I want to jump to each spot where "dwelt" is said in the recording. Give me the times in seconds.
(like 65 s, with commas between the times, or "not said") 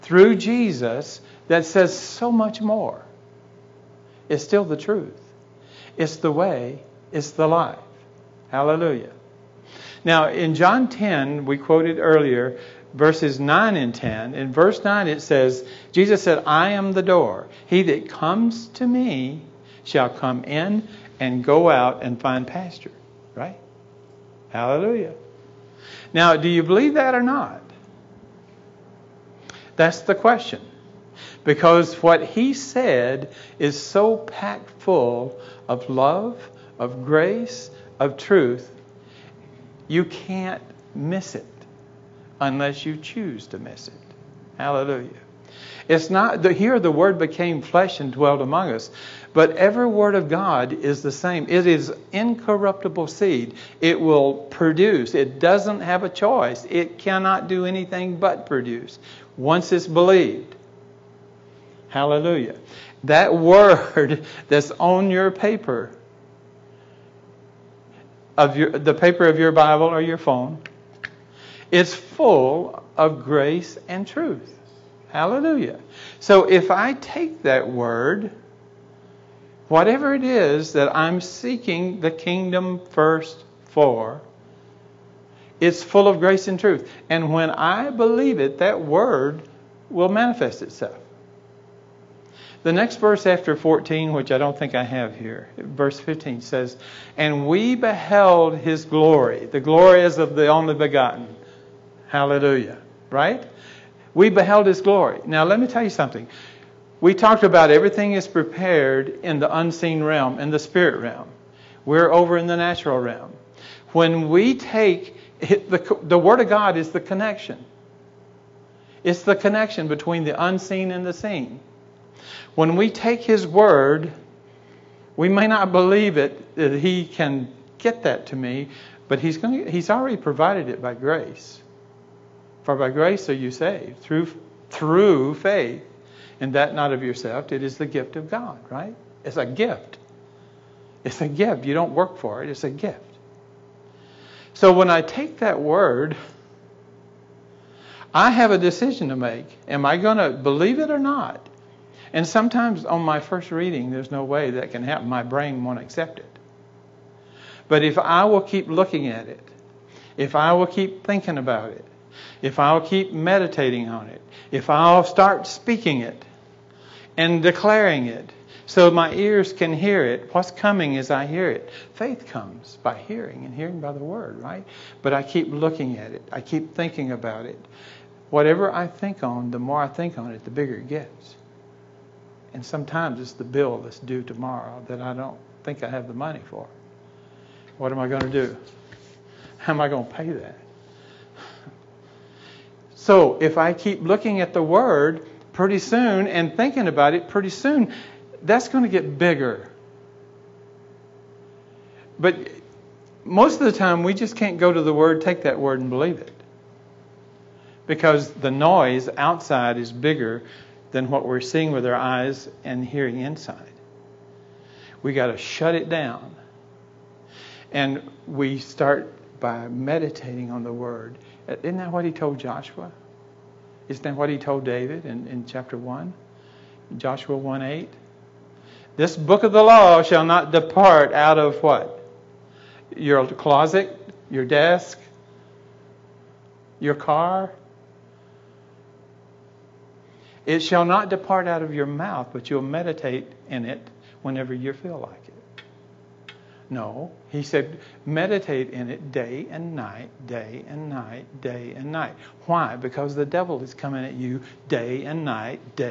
48 s.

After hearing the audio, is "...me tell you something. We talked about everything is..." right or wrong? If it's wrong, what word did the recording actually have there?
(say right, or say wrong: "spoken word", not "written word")
right.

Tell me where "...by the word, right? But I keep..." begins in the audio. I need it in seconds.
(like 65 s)
173 s.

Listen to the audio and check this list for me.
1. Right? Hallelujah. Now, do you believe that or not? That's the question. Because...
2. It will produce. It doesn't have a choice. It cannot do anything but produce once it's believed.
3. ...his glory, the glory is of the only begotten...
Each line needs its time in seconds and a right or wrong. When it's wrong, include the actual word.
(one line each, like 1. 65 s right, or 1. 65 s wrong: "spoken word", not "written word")
1. 23 s right
2. 53 s right
3. 98 s right.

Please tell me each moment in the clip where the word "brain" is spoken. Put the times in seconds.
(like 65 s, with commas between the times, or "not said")
155 s.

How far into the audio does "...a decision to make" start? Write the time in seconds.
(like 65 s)
148 s.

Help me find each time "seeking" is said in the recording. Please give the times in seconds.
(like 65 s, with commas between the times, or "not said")
81 s.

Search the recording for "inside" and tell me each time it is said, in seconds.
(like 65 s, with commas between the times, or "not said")
213 s.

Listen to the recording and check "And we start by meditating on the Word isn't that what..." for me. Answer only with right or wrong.
right.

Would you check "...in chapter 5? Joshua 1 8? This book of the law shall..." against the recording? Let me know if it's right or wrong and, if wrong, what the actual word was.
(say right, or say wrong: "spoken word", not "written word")
wrong: "1", not "5".